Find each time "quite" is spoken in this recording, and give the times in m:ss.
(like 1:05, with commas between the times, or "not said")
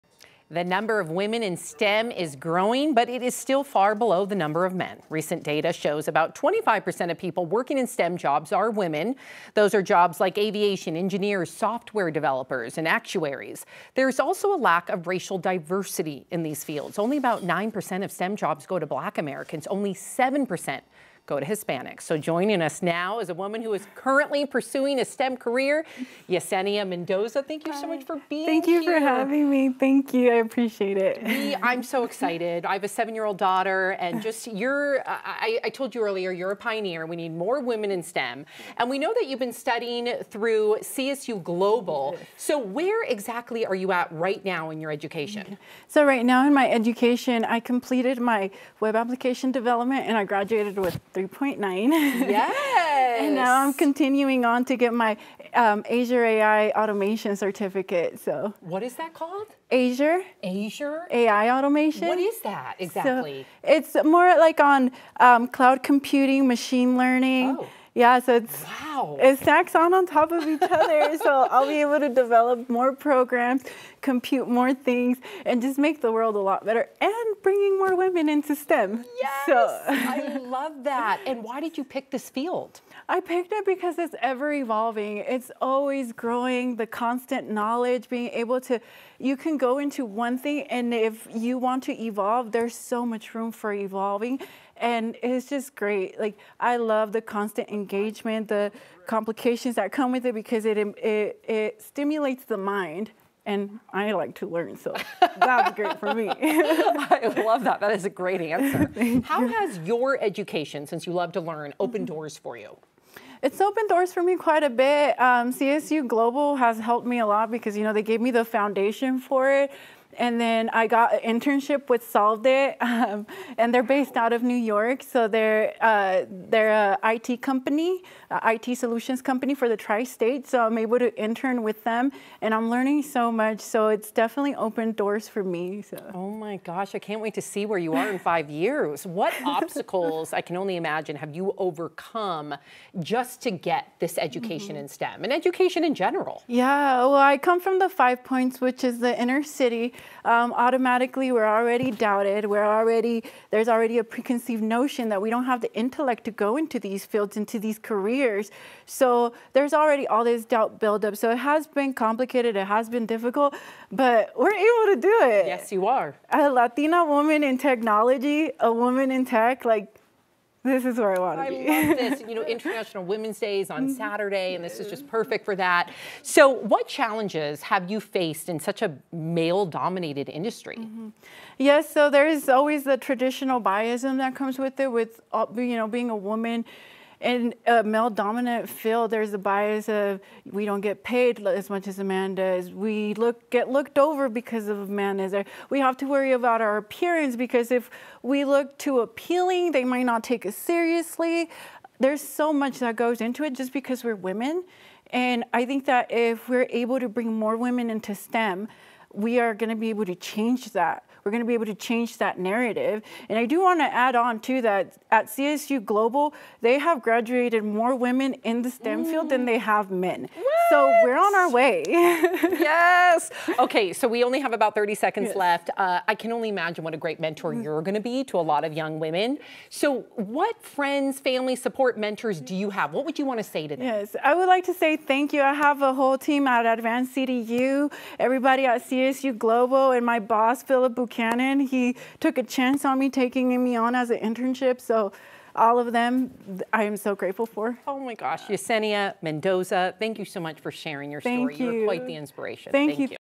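1:54, 4:11.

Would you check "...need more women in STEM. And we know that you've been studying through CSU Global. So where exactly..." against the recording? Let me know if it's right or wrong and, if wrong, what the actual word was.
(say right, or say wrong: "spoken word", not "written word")
right.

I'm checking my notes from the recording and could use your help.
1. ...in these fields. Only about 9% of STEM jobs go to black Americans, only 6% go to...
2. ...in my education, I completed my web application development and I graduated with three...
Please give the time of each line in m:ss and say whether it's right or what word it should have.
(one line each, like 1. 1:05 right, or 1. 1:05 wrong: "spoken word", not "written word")
1. 0:16 wrong: "7", not "6"
2. 0:46 right.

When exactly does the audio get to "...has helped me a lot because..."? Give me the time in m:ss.
1:56.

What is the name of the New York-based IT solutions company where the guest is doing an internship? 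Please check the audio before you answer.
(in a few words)
Solved It.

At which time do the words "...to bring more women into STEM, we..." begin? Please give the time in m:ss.
3:26.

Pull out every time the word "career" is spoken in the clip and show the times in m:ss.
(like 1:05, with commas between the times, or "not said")
0:25, 2:37.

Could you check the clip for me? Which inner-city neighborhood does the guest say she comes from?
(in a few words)
Five Points.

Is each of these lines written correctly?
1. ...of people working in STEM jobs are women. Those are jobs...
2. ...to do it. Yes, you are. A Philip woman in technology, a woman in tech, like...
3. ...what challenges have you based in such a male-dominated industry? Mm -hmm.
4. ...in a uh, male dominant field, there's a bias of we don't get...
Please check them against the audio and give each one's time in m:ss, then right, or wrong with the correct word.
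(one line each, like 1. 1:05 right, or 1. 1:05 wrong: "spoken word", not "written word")
1. 0:07 right
2. 2:44 wrong: "Latina", not "Philip"
3. 2:56 wrong: "faced", not "based"
4. 3:07 right.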